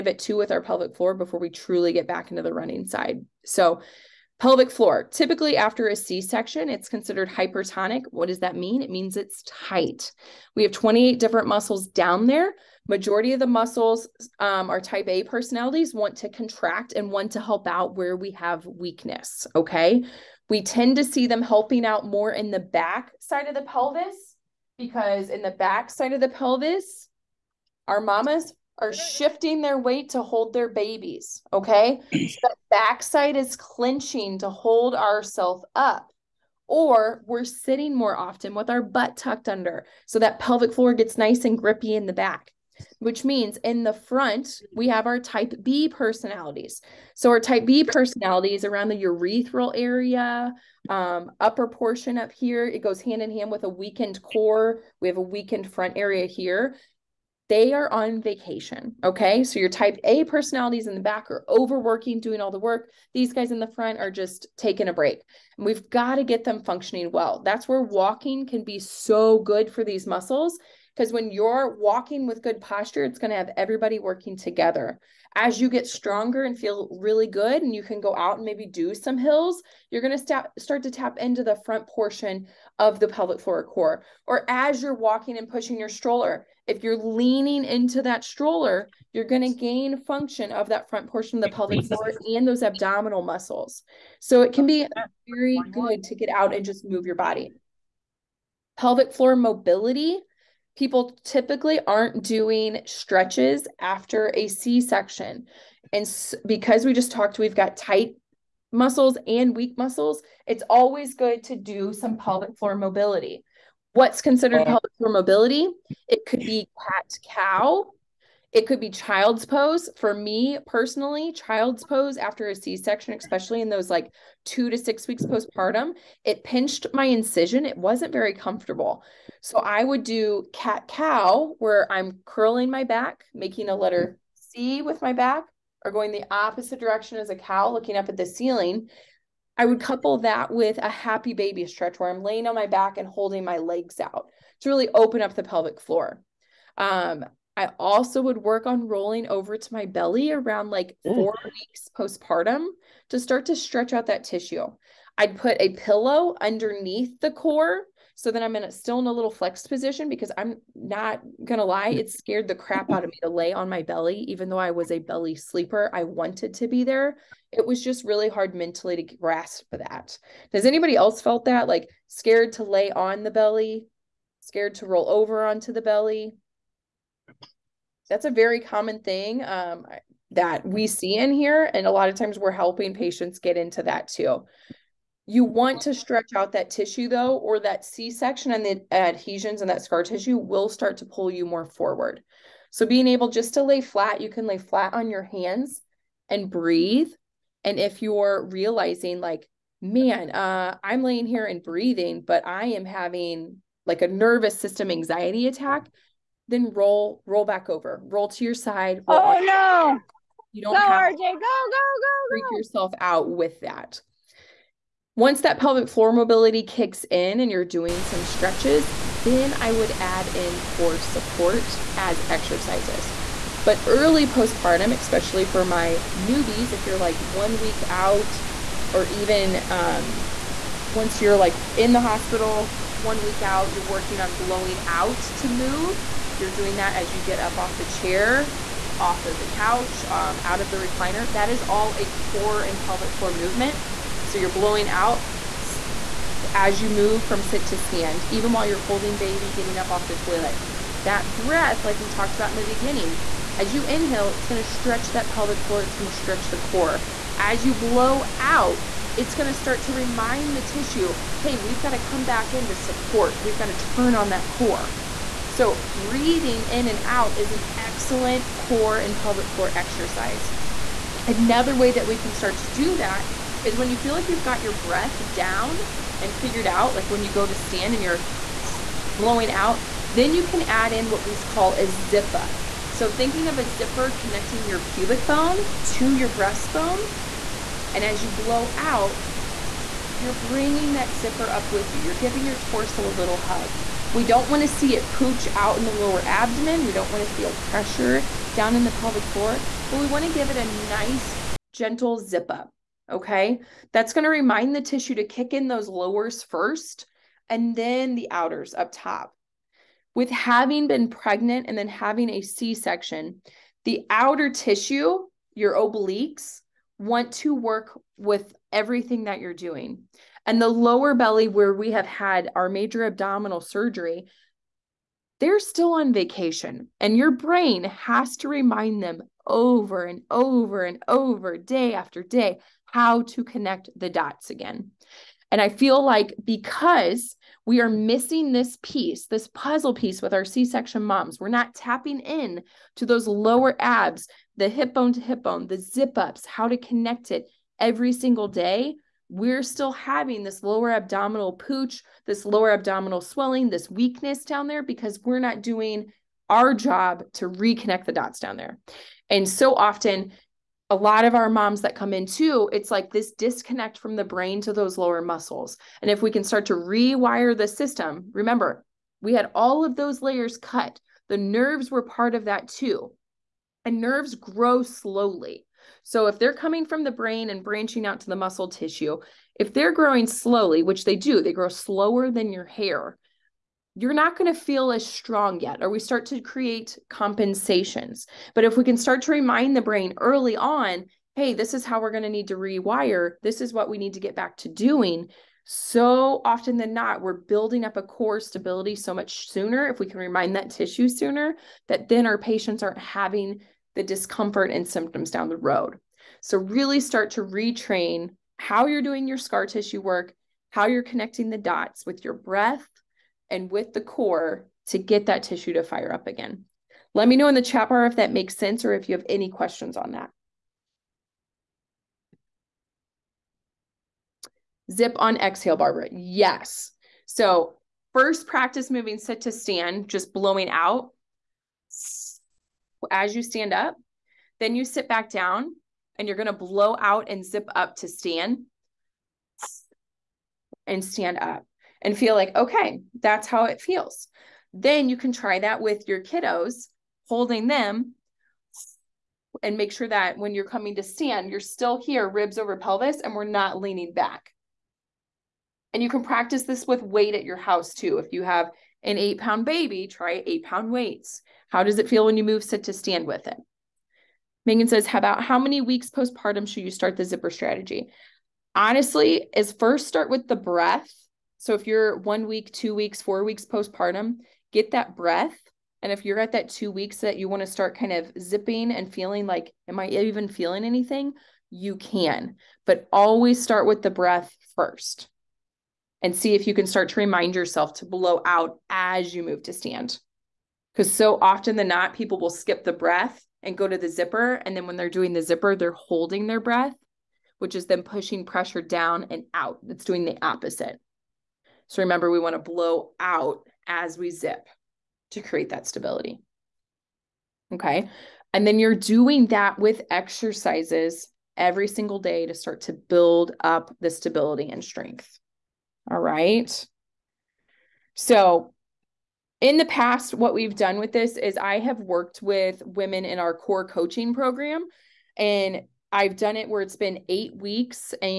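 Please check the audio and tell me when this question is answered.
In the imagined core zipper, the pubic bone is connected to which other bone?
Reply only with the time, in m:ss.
4:46.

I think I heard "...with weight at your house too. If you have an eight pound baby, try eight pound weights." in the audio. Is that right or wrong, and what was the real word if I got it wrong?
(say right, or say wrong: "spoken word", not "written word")
right.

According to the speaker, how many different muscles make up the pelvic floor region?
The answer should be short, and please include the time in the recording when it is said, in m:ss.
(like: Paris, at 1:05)
28, at 0:10.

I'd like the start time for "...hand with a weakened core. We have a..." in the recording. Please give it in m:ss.
0:53.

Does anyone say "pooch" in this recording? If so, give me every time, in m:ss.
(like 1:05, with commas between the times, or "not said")
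4:55, 5:51.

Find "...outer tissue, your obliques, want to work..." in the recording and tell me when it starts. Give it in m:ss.
5:14.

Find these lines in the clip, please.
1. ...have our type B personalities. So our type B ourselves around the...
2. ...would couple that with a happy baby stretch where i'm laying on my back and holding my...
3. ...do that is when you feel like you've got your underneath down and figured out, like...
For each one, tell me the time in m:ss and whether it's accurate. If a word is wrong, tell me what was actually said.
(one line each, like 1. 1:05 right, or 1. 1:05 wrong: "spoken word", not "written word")
1. 0:44 wrong: "personalities", not "ourselves"
2. 2:19 right
3. 4:32 wrong: "breath", not "underneath".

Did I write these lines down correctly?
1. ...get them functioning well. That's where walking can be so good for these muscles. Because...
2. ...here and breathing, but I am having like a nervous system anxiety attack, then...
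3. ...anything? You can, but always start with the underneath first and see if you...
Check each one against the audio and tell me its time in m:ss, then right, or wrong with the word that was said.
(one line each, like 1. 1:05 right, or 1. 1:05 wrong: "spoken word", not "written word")
1. 1:06 right
2. 3:21 right
3. 8:00 wrong: "breath", not "underneath".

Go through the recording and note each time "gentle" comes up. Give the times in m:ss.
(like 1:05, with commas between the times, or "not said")
5:01.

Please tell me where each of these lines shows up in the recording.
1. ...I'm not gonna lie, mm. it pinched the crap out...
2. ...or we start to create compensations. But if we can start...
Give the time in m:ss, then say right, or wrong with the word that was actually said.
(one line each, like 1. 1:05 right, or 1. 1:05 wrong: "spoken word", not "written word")
1. 2:40 wrong: "scared", not "pinched"
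2. 6:25 right.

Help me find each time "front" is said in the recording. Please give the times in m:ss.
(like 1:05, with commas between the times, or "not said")
0:43, 0:55, 1:03, 1:21, 1:30.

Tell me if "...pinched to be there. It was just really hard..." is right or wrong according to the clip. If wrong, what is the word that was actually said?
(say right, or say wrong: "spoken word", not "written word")
wrong: "wanted", not "pinched".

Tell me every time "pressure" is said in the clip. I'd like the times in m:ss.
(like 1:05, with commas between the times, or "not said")
4:57, 8:18.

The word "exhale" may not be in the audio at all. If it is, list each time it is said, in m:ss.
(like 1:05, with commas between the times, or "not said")
7:05.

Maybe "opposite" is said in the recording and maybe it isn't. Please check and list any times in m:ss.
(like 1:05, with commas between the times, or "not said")
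2:16, 8:20.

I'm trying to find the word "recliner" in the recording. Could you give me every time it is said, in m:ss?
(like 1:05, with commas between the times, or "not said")
4:00.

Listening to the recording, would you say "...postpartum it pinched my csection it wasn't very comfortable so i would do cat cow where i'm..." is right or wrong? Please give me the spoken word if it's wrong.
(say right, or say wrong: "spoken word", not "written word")
wrong: "incision", not "csection".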